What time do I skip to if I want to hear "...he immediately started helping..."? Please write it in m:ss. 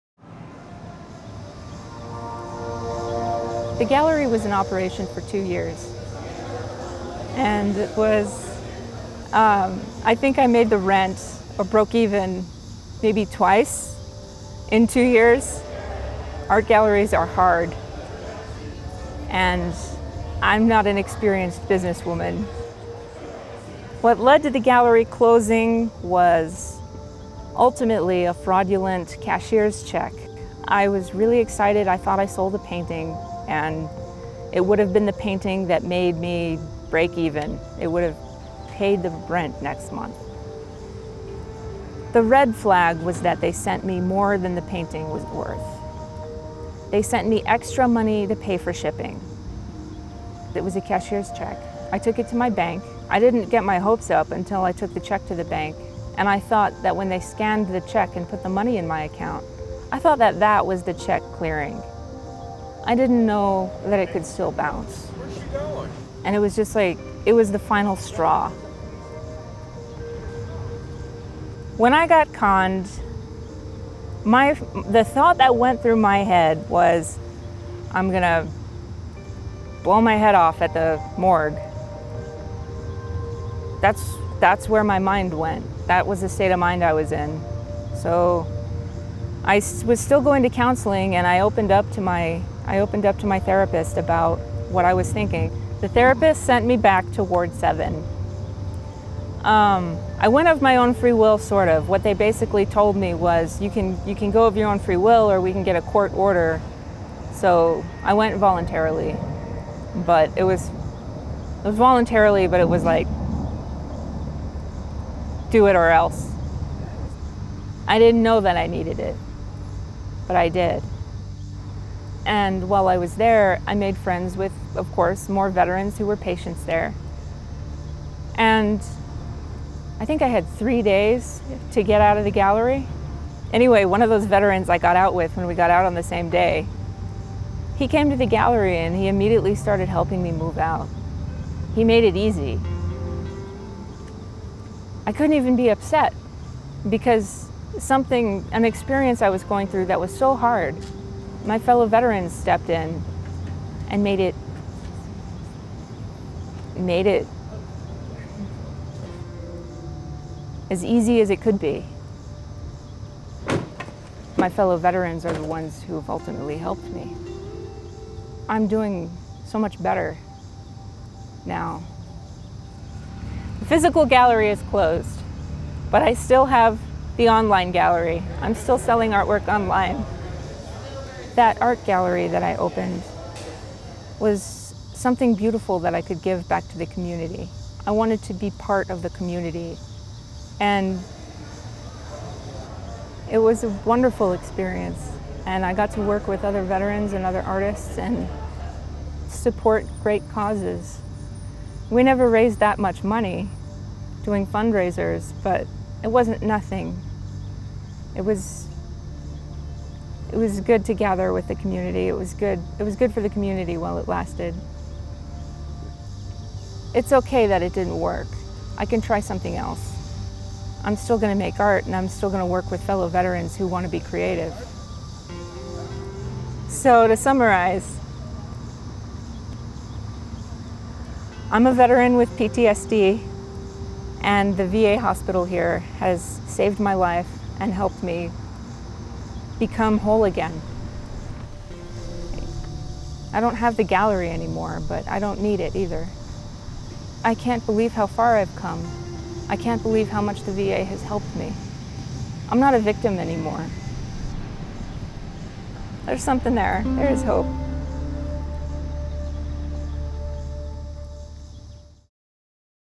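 2:18.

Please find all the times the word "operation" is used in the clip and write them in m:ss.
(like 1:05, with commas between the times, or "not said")
0:04.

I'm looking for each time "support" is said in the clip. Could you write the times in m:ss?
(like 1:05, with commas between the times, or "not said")
3:19.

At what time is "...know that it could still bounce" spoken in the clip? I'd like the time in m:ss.
1:03.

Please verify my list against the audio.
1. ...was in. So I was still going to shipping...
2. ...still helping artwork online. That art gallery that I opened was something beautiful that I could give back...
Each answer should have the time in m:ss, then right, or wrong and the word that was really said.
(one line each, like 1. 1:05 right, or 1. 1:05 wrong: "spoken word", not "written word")
1. 1:26 wrong: "counseling", not "shipping"
2. 2:58 wrong: "selling", not "helping".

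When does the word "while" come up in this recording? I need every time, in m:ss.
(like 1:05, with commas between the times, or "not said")
2:02, 3:33.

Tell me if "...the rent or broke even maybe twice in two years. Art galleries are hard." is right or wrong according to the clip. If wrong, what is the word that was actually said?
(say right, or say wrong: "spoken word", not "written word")
right.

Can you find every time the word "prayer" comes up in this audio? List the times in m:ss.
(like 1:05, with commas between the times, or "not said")
not said.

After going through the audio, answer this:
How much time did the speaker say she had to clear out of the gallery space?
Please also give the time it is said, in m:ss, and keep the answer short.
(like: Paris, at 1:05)
3 days, at 2:10.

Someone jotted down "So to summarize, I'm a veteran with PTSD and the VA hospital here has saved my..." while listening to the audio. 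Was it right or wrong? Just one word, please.
right.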